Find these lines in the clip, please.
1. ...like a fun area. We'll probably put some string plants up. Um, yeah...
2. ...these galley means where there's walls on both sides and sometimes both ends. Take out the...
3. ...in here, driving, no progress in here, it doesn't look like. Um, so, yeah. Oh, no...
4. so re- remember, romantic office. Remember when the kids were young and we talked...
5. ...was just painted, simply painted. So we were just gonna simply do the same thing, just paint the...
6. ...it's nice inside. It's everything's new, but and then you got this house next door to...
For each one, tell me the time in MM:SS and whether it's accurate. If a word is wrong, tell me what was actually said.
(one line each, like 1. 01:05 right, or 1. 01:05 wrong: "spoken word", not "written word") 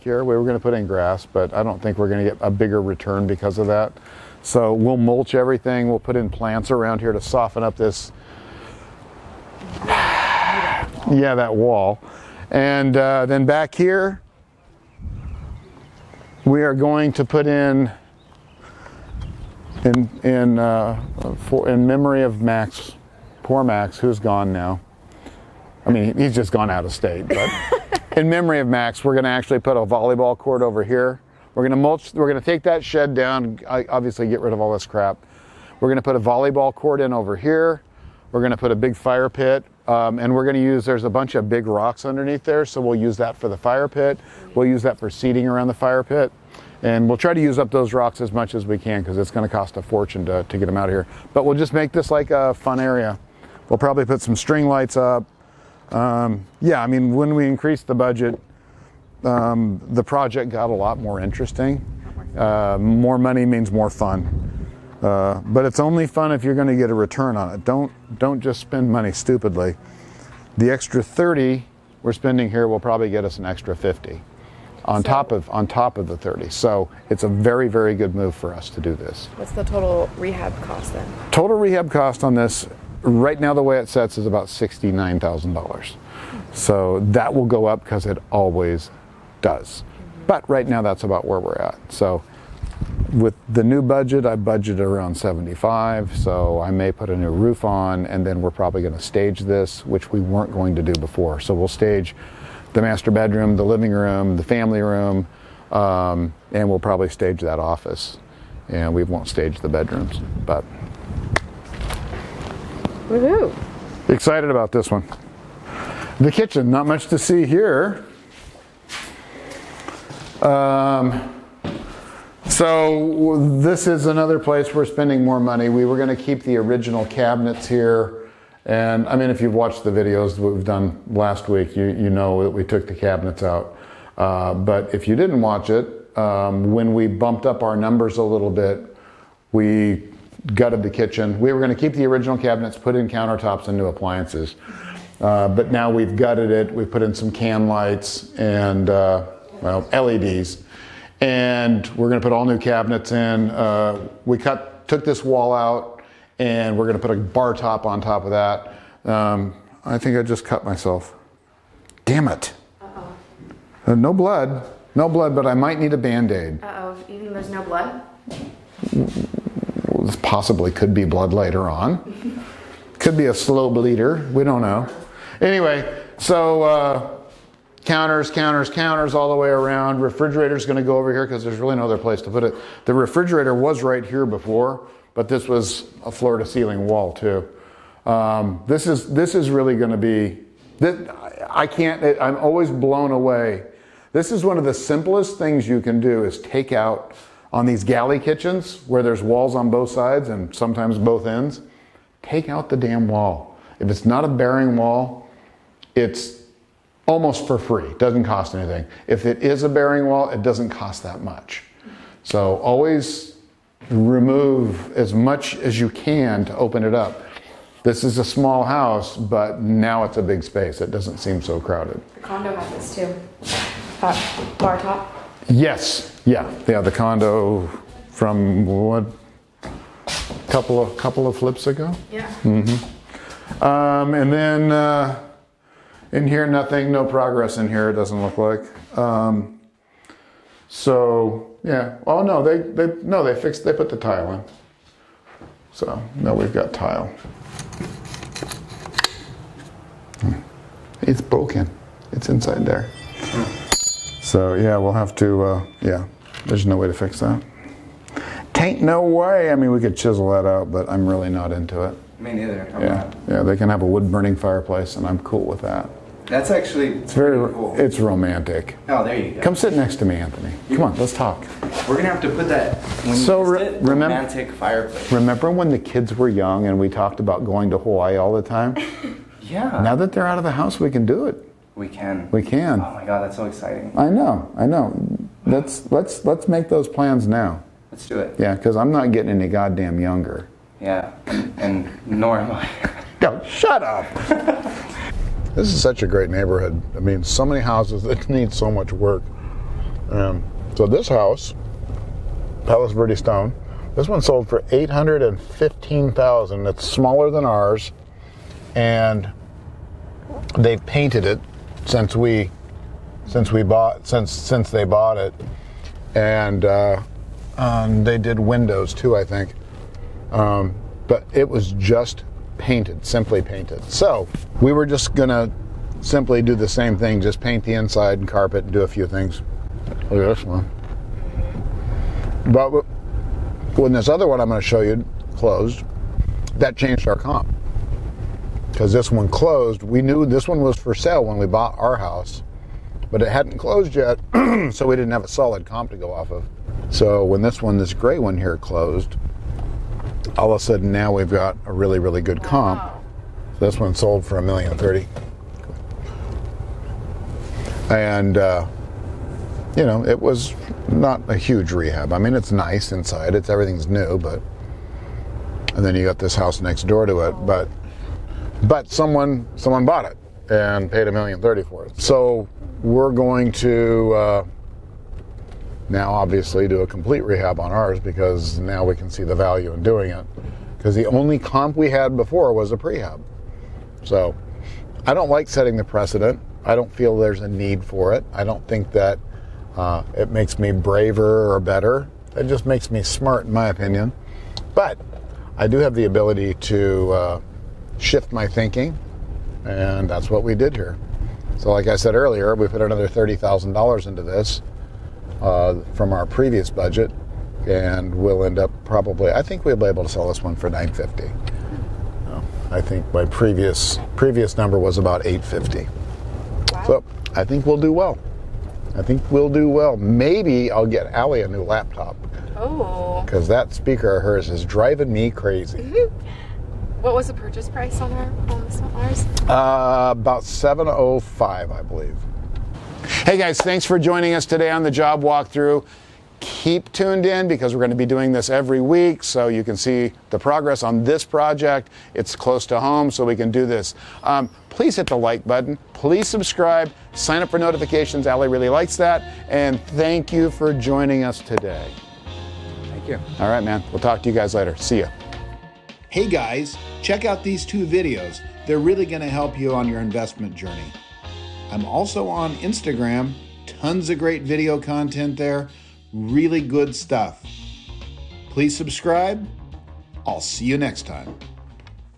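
1. 00:52 wrong: "lights", not "plants"
2. 03:17 wrong: "kitchens", not "means"
3. 03:56 wrong: "nothing", not "driving"
4. 04:33 wrong: "fireplace", not "office"
5. 05:21 right
6. 06:02 right.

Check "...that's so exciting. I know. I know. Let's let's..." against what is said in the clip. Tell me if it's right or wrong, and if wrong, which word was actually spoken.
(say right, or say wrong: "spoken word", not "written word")
right.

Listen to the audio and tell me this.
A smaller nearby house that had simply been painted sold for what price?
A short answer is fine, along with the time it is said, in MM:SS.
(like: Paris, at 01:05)
$815,000, at 05:04.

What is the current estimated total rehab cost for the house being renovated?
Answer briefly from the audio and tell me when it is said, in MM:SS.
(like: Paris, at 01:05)
$69,000, at 01:24.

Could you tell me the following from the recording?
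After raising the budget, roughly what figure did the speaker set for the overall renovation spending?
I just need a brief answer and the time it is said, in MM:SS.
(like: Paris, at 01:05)
75, at 01:35.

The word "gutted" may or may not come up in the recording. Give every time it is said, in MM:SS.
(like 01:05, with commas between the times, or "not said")
02:20, 02:26.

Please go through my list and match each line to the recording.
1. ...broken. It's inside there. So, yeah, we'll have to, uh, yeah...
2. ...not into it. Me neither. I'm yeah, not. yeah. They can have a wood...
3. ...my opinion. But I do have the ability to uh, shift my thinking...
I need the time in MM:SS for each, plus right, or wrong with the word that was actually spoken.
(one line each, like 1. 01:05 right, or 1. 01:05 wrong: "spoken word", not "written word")
1. 04:11 right
2. 04:21 right
3. 06:33 right.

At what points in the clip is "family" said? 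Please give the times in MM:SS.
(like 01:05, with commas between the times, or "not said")
01:44.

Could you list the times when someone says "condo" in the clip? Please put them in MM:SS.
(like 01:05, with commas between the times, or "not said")
03:42, 03:46.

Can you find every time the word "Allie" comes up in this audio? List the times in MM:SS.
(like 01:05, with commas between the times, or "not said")
07:01, 07:28.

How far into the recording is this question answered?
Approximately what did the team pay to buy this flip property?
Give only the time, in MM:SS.
07:10.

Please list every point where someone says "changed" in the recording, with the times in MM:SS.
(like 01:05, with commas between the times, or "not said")
05:36.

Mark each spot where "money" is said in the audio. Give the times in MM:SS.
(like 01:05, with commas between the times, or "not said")
01:03, 01:08, 02:05.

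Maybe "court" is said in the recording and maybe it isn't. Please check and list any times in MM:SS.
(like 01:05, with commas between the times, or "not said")
00:30, 00:36.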